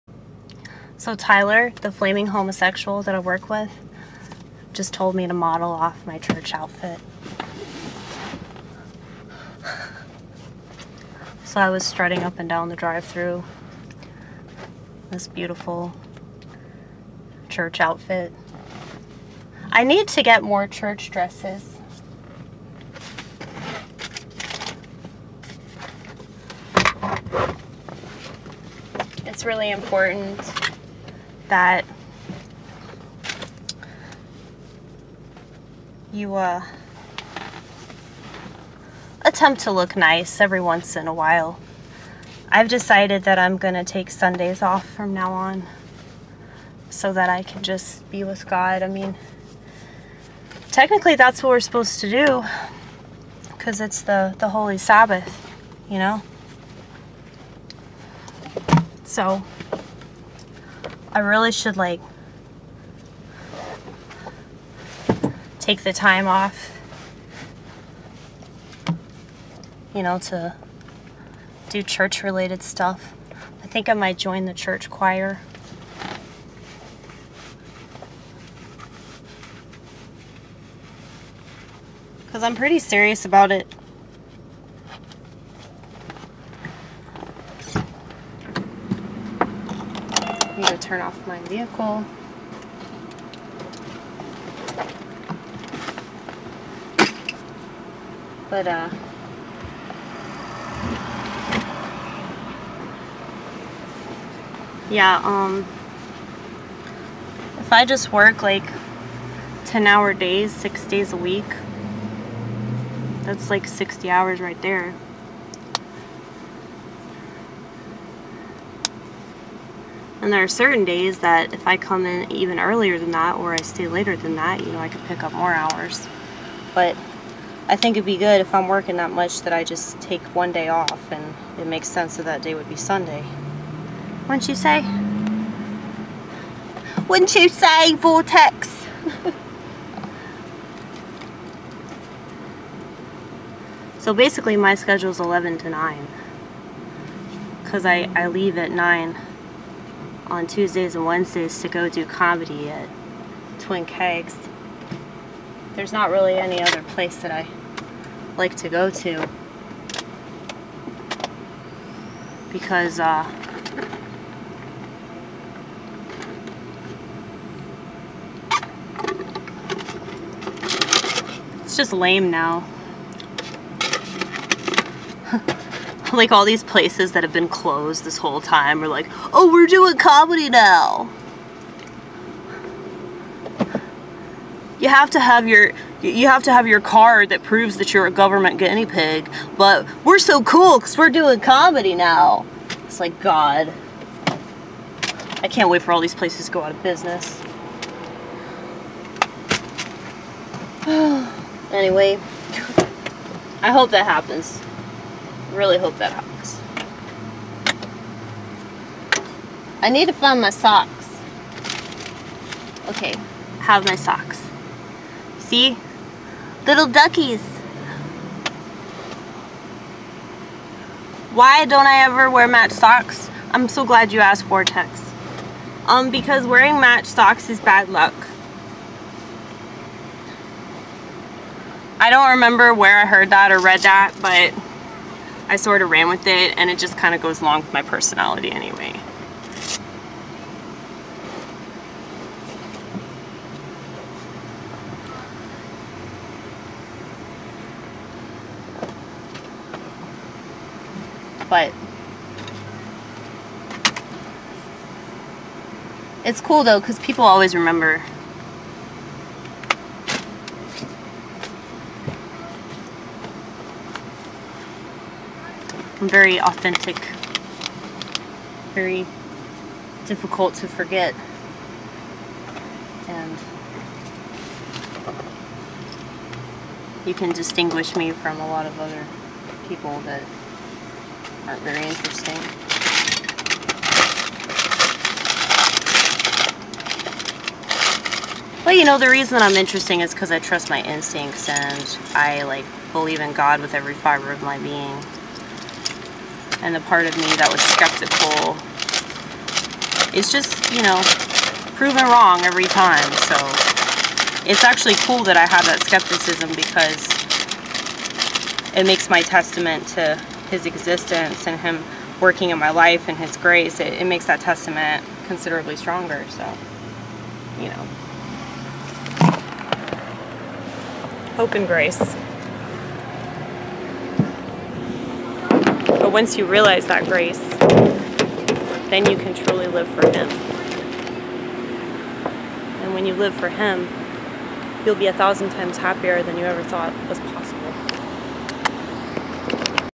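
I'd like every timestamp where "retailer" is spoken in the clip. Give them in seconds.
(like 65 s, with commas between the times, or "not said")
not said.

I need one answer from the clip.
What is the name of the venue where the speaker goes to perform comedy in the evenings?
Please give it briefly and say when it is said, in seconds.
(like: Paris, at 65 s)
Twin Kegs, at 153 s.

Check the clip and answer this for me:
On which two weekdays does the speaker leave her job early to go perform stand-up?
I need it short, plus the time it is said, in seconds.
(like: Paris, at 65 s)
Tuesdays and Wednesdays, at 150 s.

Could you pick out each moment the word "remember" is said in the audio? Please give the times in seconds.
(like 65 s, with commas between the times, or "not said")
232 s, 257 s.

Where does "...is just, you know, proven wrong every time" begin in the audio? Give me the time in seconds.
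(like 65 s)
300 s.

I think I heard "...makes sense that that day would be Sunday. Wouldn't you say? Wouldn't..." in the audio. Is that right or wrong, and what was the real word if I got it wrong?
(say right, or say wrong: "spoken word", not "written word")
right.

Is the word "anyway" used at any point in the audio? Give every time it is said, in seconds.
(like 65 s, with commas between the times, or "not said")
201 s, 238 s.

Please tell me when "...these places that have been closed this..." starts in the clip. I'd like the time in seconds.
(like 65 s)
176 s.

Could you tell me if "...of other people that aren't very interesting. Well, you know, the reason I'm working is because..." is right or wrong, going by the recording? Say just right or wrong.
wrong.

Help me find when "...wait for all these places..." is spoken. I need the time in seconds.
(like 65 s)
195 s.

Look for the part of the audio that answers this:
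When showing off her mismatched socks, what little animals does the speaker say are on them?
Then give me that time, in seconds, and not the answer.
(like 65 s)
216 s.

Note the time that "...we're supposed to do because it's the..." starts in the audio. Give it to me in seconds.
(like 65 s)
51 s.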